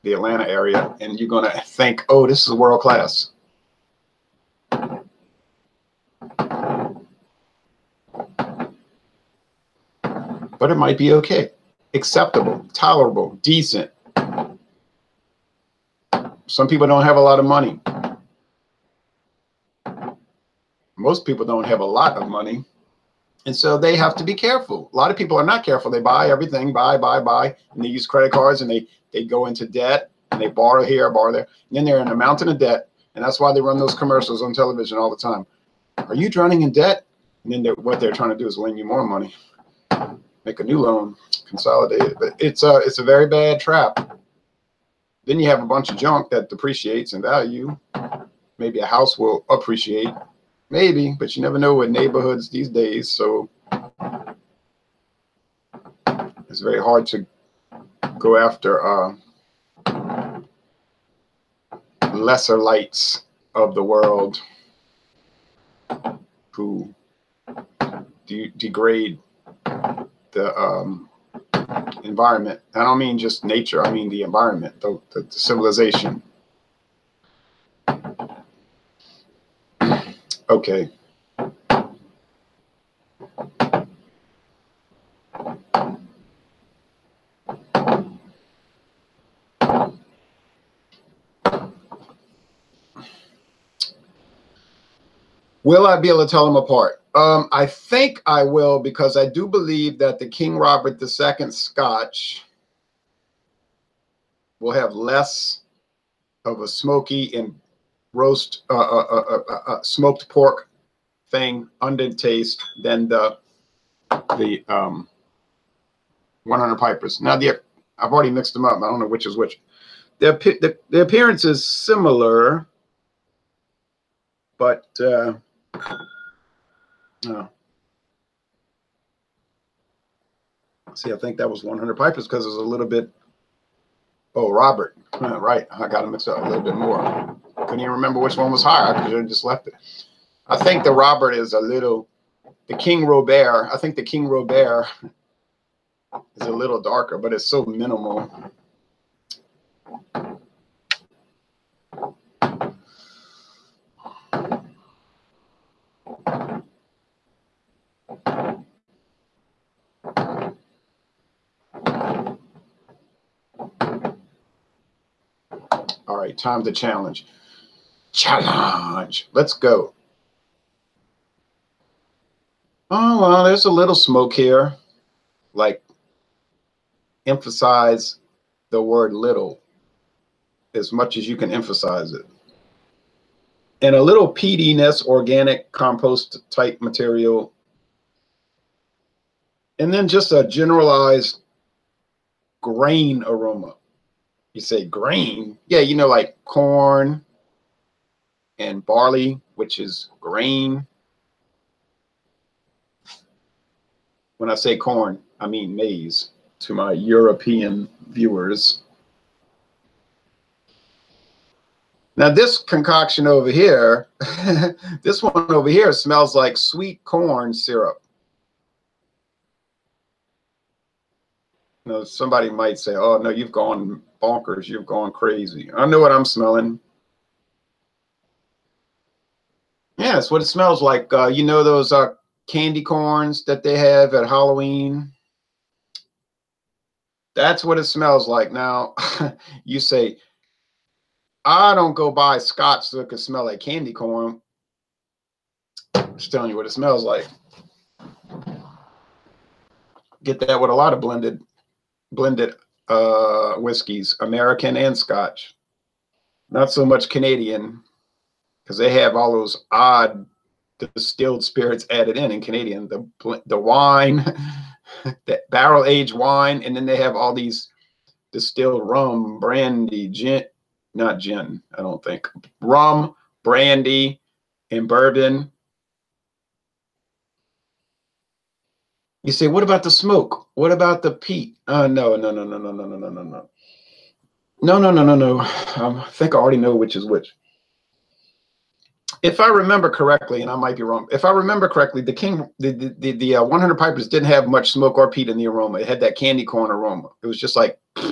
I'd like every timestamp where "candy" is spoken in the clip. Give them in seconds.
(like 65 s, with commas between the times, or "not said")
232 s, 243 s, 296 s.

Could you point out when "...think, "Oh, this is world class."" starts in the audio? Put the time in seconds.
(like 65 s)
1 s.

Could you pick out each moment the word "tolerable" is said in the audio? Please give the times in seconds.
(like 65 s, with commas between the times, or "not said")
12 s.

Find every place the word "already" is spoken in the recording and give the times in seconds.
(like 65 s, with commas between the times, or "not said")
118 s, 286 s.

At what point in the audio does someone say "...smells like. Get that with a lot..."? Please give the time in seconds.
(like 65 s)
246 s.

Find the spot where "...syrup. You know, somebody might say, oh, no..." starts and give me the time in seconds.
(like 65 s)
217 s.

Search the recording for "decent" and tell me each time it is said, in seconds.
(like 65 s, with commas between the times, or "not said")
13 s.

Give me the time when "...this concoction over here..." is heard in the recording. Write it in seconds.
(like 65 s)
212 s.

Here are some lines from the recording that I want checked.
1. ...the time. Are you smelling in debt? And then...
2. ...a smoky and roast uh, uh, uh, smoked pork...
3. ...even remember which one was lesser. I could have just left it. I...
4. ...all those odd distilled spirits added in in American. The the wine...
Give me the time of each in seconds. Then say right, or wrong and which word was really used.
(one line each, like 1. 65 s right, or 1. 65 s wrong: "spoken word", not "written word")
1. 35 s wrong: "drowning", not "smelling"
2. 106 s right
3. 137 s wrong: "higher", not "lesser"
4. 259 s wrong: "Canadian", not "American".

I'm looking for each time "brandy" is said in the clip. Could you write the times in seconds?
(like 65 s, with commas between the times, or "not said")
269 s, 273 s.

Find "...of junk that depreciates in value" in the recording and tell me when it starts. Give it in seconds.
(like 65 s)
45 s.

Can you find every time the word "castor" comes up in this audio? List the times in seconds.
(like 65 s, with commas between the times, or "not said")
not said.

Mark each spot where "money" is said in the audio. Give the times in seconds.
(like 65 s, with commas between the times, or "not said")
17 s, 22 s, 39 s.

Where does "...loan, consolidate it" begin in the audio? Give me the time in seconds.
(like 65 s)
40 s.